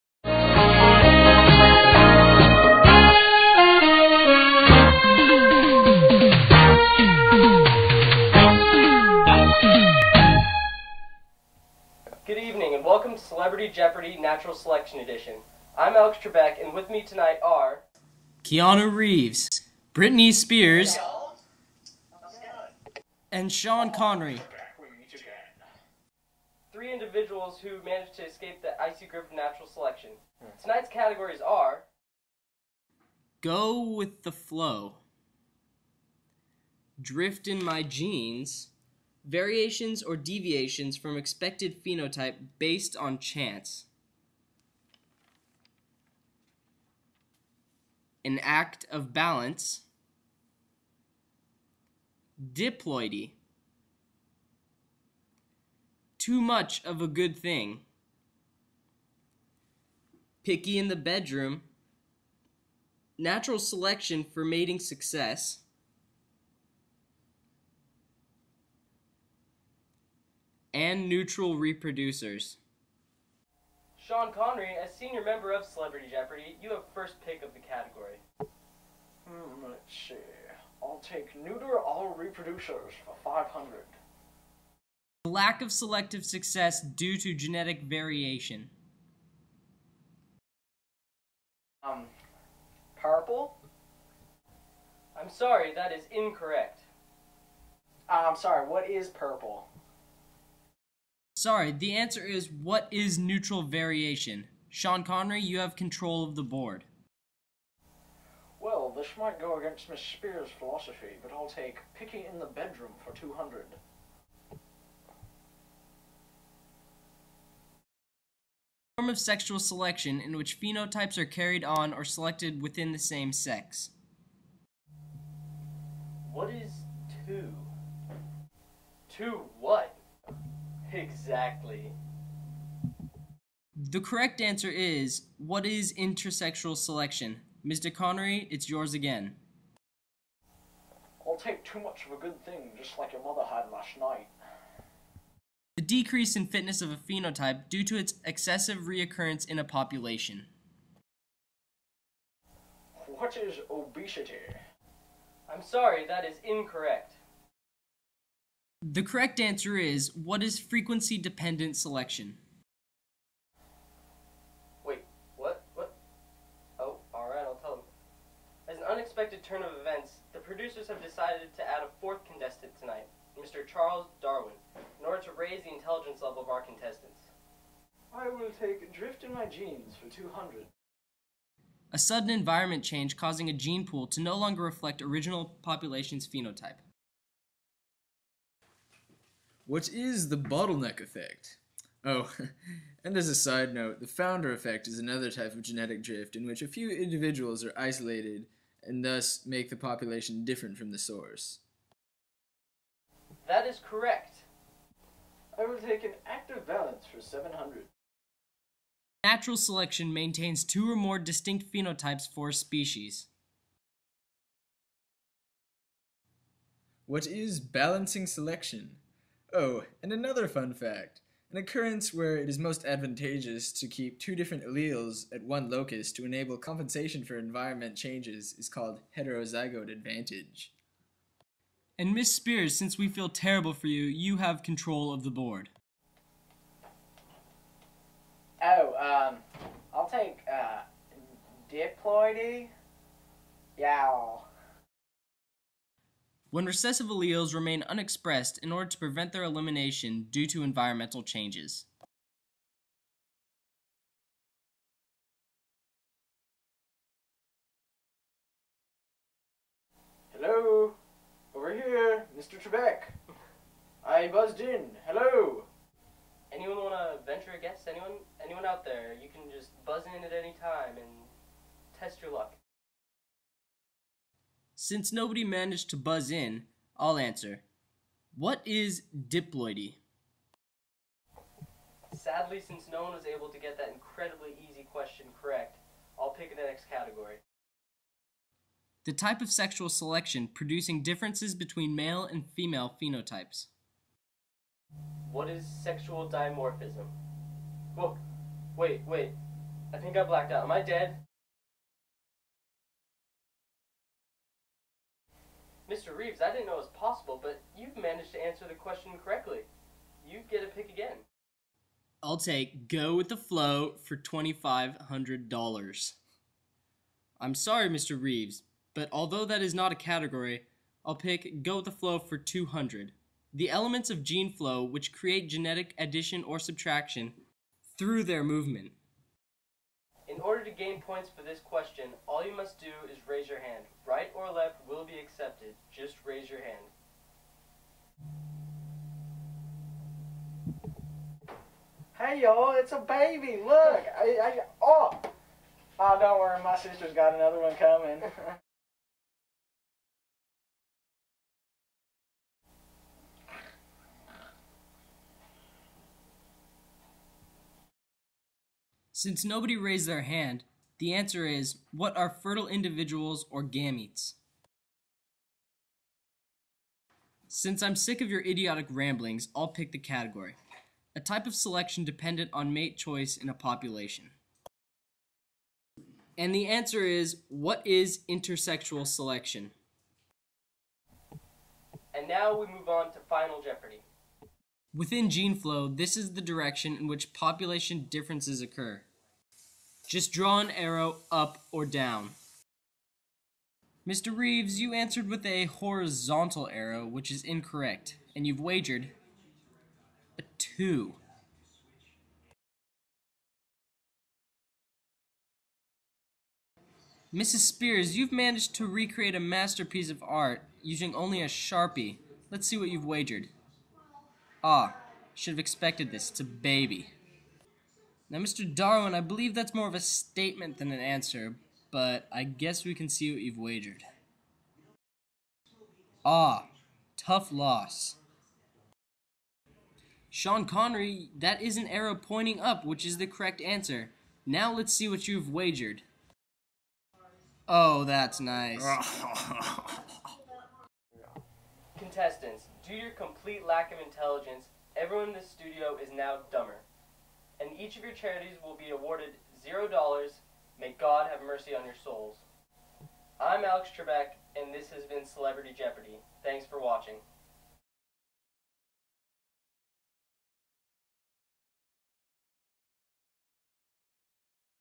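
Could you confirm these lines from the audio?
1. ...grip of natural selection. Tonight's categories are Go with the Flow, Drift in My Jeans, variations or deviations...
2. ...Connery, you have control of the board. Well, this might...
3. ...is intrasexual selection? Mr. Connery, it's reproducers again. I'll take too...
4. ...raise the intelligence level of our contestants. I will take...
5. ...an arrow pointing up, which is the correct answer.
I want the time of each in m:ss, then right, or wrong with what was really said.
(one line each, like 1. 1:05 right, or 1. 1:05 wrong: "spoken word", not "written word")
1. 0:29 right
2. 1:45 right
3. 2:15 wrong: "yours", not "reproducers"
4. 2:55 right
5. 7:11 right.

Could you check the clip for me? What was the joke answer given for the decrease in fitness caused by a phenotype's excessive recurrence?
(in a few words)
Obesity.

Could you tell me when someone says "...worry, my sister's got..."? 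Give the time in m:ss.
5:46.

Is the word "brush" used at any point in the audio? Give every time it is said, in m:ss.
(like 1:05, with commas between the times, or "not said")
not said.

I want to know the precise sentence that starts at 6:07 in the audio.
Since I'm sick of your idiotic ramblings, I'll pick the category.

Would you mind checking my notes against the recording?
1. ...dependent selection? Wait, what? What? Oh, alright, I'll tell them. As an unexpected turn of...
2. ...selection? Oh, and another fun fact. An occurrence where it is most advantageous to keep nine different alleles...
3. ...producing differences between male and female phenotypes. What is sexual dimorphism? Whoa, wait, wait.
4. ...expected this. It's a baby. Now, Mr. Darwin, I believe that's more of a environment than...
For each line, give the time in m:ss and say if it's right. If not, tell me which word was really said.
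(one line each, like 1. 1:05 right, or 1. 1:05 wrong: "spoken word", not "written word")
1. 2:41 right
2. 3:38 wrong: "two", not "nine"
3. 4:50 right
4. 6:55 wrong: "statement", not "environment".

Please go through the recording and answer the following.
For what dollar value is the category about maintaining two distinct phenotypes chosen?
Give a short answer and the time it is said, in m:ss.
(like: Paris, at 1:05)
700, at 3:27.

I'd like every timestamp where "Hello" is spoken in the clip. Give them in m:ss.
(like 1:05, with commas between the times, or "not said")
4:20, 4:25.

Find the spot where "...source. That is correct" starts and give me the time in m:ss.
3:20.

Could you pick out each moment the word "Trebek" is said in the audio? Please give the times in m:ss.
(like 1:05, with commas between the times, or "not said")
0:16, 4:22, 7:33.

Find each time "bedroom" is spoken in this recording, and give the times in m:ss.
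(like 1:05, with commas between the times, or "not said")
1:00, 1:52.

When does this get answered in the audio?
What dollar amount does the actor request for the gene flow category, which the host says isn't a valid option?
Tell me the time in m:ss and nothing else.
5:14.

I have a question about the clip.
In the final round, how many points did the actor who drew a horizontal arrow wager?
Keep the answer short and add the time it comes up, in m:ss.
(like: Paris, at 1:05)
2, at 6:40.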